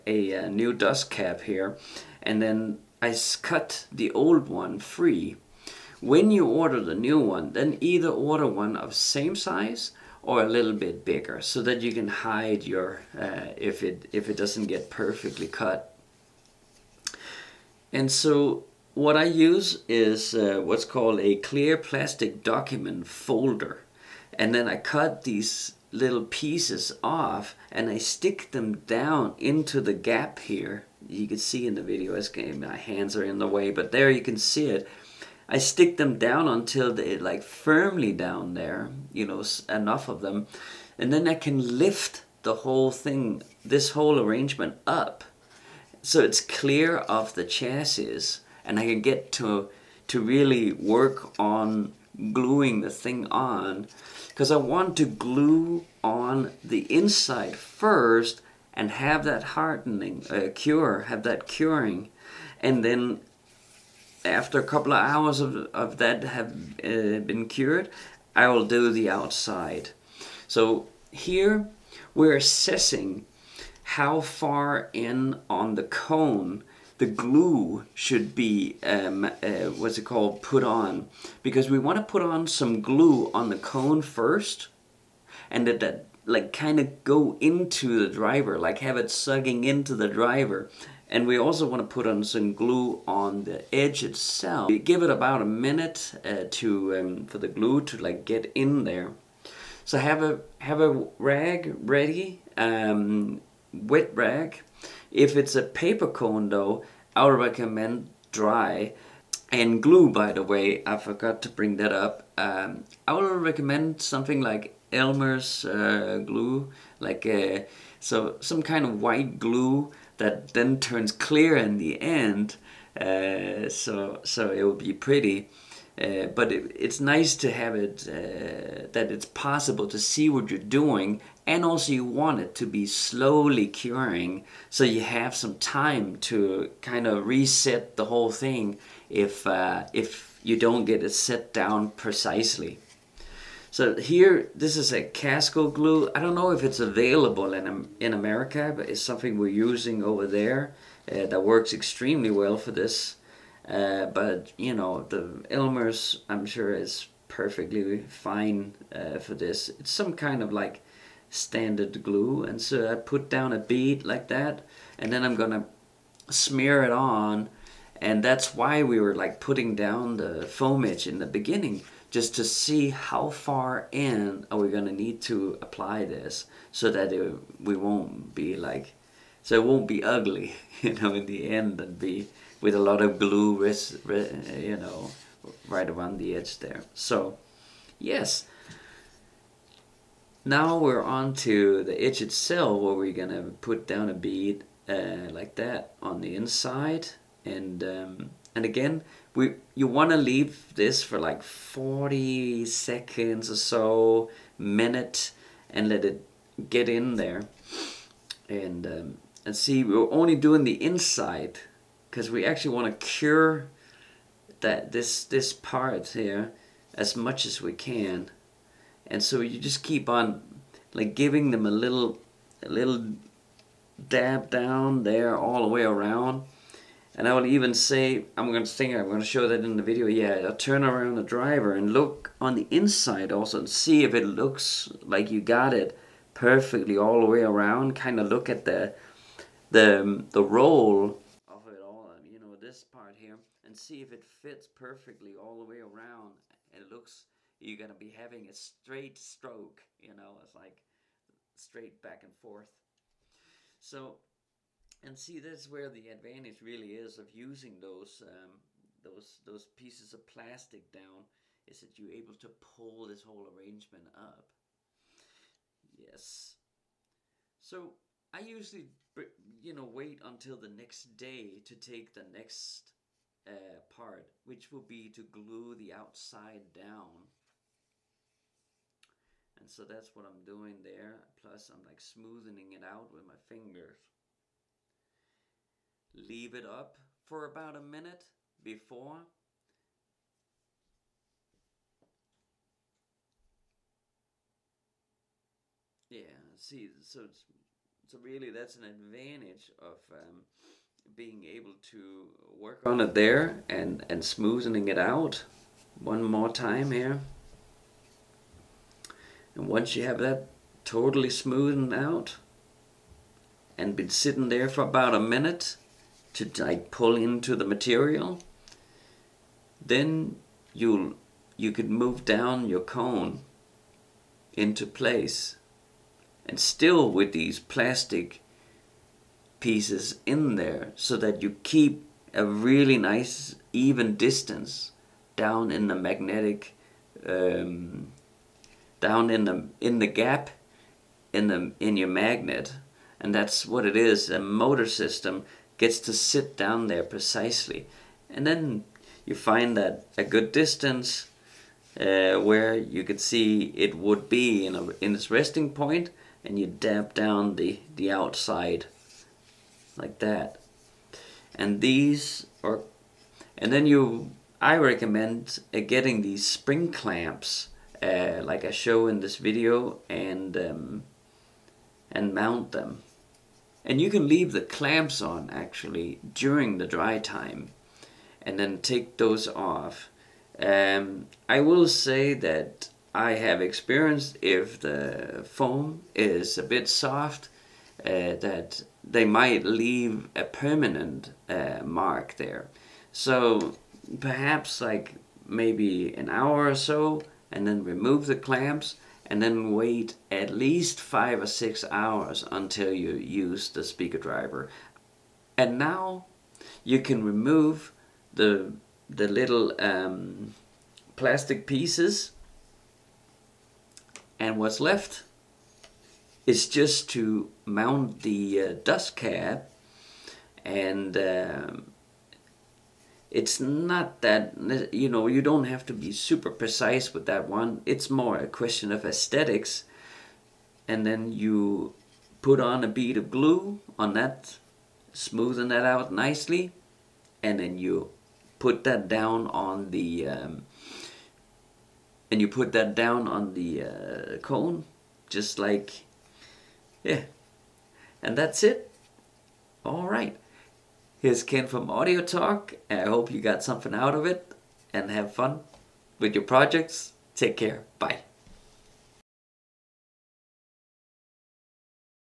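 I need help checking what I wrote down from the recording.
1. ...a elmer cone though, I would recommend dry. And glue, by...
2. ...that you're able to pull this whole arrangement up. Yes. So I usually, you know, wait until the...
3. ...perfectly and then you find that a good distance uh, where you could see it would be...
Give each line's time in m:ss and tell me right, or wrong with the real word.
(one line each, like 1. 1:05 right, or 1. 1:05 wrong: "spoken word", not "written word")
1. 1:45 wrong: "paper", not "elmer"
2. 4:21 right
3. 5:47 wrong: "precisely", not "perfectly".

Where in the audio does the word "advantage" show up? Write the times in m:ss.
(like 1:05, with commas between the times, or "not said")
4:16, 4:58.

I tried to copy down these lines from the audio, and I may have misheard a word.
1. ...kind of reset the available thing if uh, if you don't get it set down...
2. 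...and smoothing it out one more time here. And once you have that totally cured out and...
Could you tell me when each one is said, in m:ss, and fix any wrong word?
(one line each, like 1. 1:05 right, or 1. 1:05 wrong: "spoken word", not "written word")
1. 2:16 wrong: "whole", not "available"
2. 5:04 wrong: "smoothed", not "cured".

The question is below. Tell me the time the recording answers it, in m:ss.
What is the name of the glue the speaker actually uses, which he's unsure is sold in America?
2:25.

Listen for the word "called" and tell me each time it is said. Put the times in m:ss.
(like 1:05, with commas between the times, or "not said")
0:20, 1:20.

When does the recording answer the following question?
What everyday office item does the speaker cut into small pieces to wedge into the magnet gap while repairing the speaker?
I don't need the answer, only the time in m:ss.
0:21.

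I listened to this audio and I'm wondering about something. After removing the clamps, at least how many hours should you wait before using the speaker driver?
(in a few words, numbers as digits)
5 or 6.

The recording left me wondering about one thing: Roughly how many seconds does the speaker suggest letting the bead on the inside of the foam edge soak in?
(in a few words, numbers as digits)
40.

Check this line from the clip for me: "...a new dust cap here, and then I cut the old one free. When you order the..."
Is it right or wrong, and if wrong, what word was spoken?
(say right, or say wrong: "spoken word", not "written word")
right.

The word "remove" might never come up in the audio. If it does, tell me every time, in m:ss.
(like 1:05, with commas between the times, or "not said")
6:37, 6:47.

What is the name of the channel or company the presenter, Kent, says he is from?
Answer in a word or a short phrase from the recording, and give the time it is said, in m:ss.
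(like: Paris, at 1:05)
Audio Talk, at 7:31.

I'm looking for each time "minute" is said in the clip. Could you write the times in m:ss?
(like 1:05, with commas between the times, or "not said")
1:35, 3:24, 4:47, 5:15.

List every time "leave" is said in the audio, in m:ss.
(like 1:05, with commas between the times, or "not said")
3:20, 4:46, 6:14, 6:29.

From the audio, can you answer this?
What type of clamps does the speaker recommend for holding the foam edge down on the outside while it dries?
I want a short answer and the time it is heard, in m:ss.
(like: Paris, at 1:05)
spring clamps, at 6:06.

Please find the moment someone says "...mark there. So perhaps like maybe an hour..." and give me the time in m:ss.
6:31.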